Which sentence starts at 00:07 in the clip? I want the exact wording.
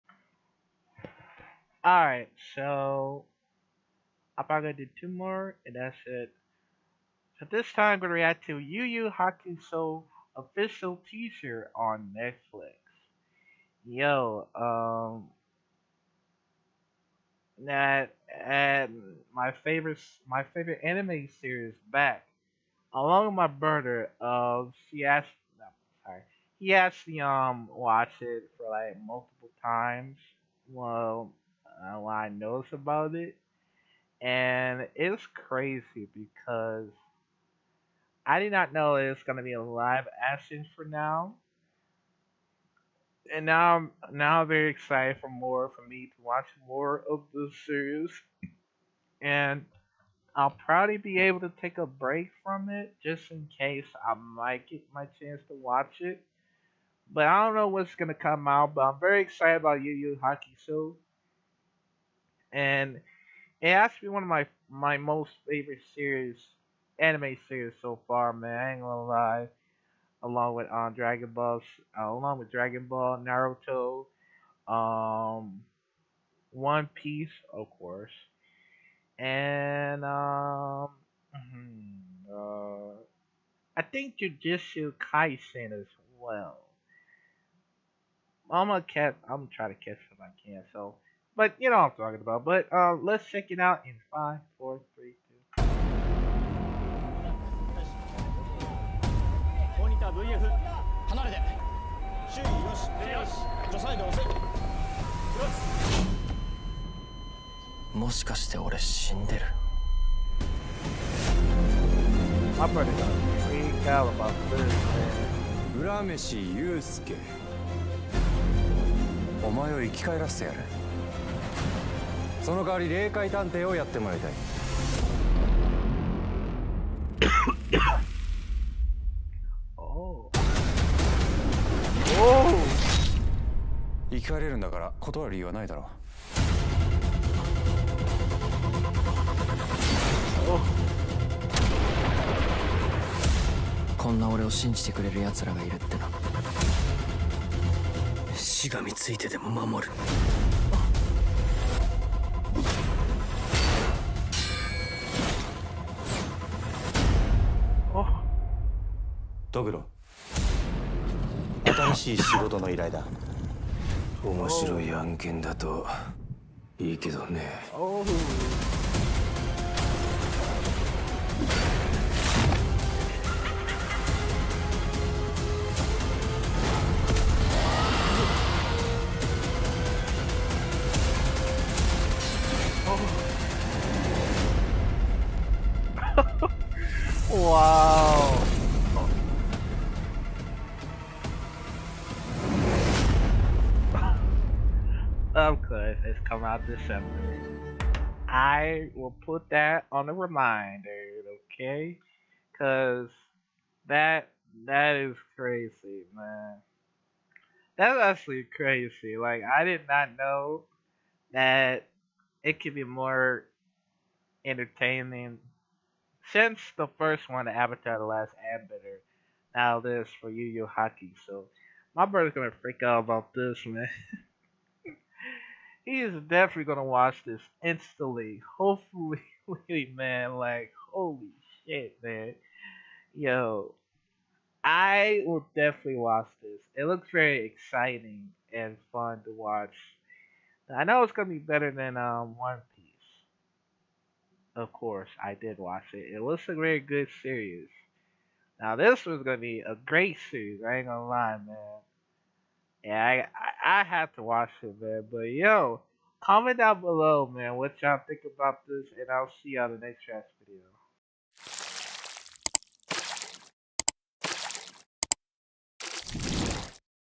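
So this time I'm gonna react to Yu Yu Hakusho official teaser on Netflix.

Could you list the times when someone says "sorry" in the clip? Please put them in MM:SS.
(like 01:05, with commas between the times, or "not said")
00:26.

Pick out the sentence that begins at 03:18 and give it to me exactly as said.
I will put that on a reminder, okay?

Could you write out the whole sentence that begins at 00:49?
and I'll probably be able to take a break from it just in case I might get my chance to watch it.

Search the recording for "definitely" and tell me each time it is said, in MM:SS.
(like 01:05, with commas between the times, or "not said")
03:46, 03:55.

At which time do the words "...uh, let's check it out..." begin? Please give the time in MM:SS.
01:32.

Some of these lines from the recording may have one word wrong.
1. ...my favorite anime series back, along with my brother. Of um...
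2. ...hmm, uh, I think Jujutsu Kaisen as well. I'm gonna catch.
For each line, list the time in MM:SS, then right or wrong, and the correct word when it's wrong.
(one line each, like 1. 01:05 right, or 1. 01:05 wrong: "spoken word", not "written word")
1. 00:20 right
2. 01:21 right.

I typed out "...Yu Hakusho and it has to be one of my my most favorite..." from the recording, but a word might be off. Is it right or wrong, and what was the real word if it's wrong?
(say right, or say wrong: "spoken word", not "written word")
right.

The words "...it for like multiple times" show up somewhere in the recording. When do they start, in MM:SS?
00:28.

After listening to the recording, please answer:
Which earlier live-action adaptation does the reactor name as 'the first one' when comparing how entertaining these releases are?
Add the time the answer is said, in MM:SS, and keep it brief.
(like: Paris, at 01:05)
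Avatar: The Last Airbender, at 03:37.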